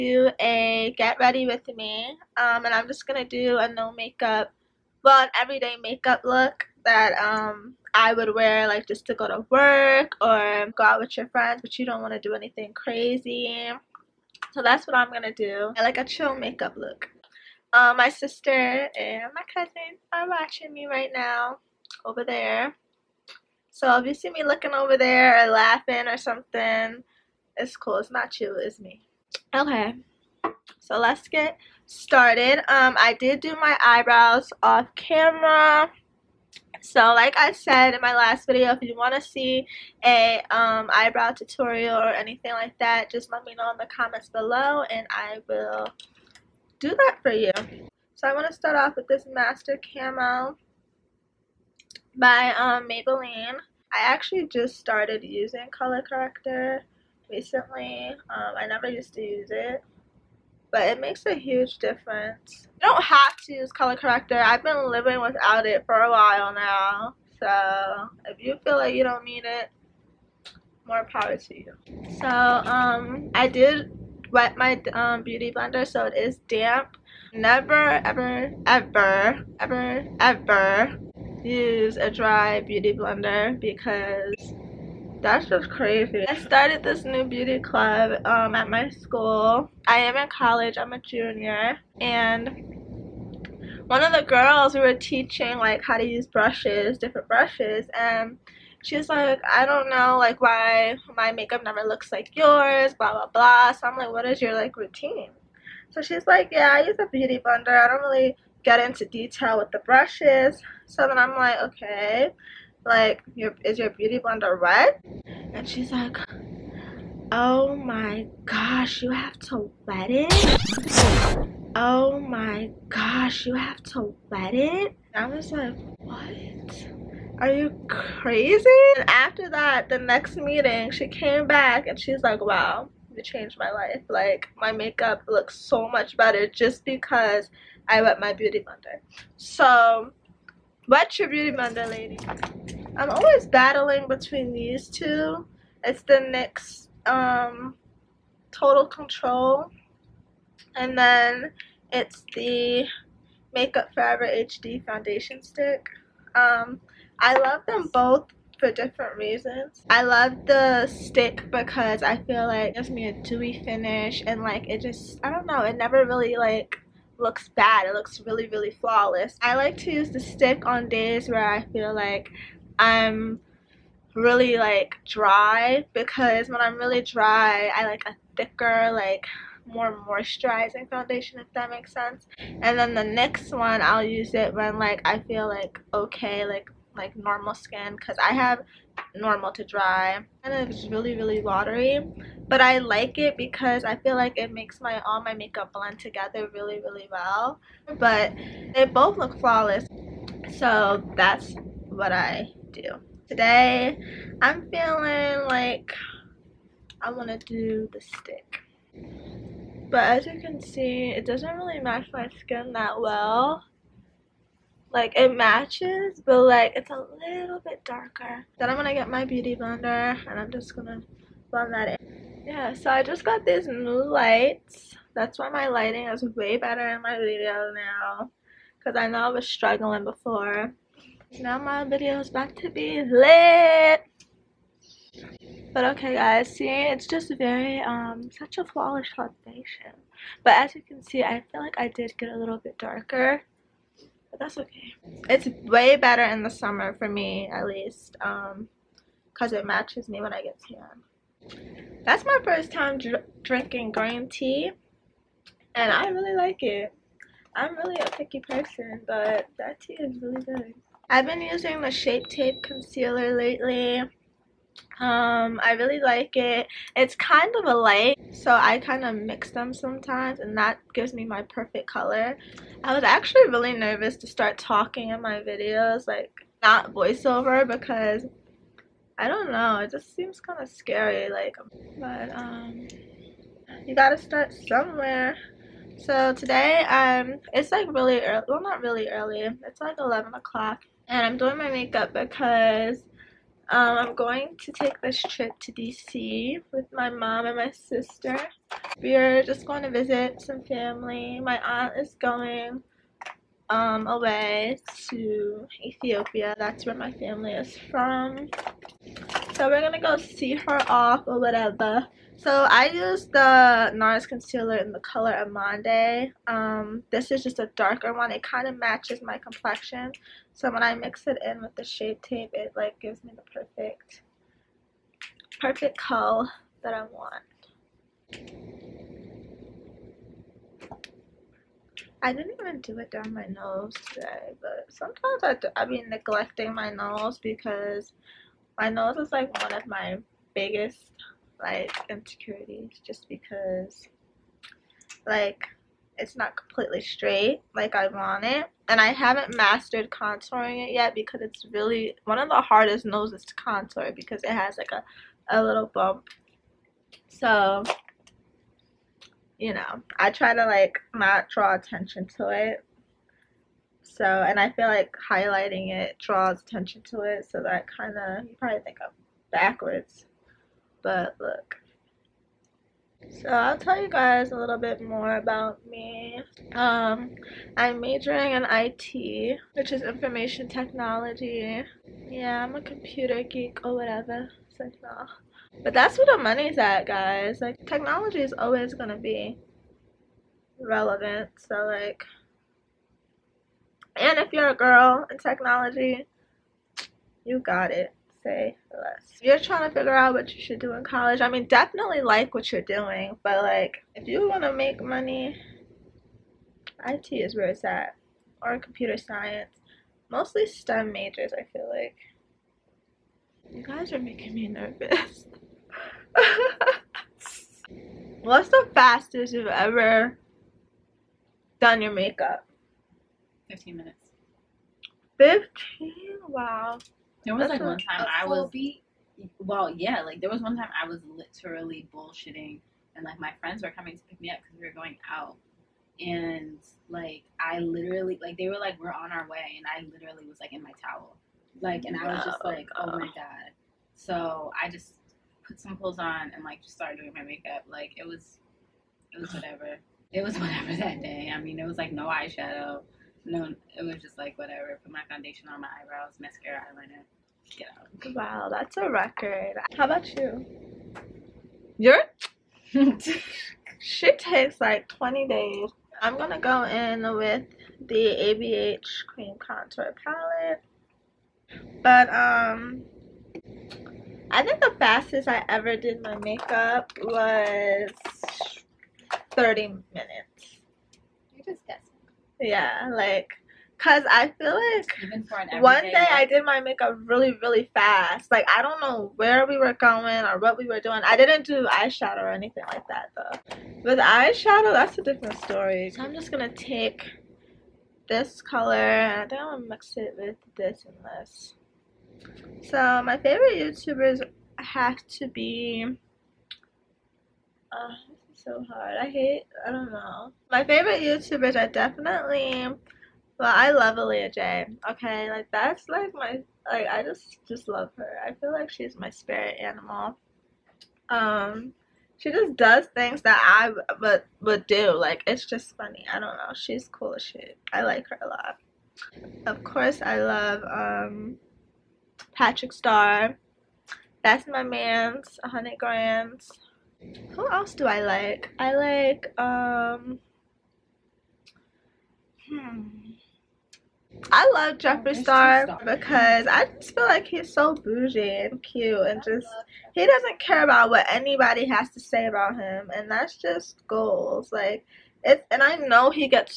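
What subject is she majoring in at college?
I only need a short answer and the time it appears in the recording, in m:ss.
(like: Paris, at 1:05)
information technology, at 6:20.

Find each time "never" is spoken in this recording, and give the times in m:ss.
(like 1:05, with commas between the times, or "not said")
0:58, 1:17, 1:41, 2:45.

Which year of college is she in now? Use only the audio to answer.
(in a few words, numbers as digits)
junior.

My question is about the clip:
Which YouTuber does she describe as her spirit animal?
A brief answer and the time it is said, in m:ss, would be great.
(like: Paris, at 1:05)
Aaliyah Jay, at 8:34.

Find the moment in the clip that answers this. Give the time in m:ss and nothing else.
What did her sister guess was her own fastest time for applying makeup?
7:59.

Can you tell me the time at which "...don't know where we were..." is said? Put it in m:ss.
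8:08.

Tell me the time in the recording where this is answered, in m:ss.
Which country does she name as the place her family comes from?
5:05.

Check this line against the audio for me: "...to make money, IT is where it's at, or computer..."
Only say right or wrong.
right.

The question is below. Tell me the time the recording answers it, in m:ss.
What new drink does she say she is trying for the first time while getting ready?
4:13.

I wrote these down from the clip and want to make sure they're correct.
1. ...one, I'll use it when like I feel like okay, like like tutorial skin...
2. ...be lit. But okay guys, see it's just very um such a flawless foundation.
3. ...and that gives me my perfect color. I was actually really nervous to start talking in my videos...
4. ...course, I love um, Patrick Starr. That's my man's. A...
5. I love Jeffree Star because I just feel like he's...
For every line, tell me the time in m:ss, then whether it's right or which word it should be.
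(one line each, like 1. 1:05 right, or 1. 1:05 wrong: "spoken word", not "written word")
1. 3:03 wrong: "normal", not "tutorial"
2. 3:52 right
3. 4:30 right
4. 8:49 right
5. 9:04 right.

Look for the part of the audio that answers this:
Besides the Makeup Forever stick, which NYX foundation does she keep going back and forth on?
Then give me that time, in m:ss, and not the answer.
2:28.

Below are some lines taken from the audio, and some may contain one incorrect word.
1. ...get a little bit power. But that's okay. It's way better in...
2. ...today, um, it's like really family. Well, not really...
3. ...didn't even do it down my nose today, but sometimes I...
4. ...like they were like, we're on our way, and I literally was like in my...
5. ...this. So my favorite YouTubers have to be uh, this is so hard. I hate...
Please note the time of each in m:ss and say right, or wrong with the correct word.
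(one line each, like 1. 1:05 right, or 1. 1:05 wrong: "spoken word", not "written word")
1. 4:02 wrong: "darker", not "power"
2. 4:46 wrong: "early", not "family"
3. 5:32 right
4. 7:18 right
5. 8:21 right.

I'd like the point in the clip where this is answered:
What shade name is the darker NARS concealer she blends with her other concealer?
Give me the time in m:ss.
5:15.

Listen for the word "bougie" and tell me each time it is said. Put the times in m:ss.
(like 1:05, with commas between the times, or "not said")
9:07.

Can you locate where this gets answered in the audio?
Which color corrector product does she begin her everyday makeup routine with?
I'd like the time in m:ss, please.
0:49.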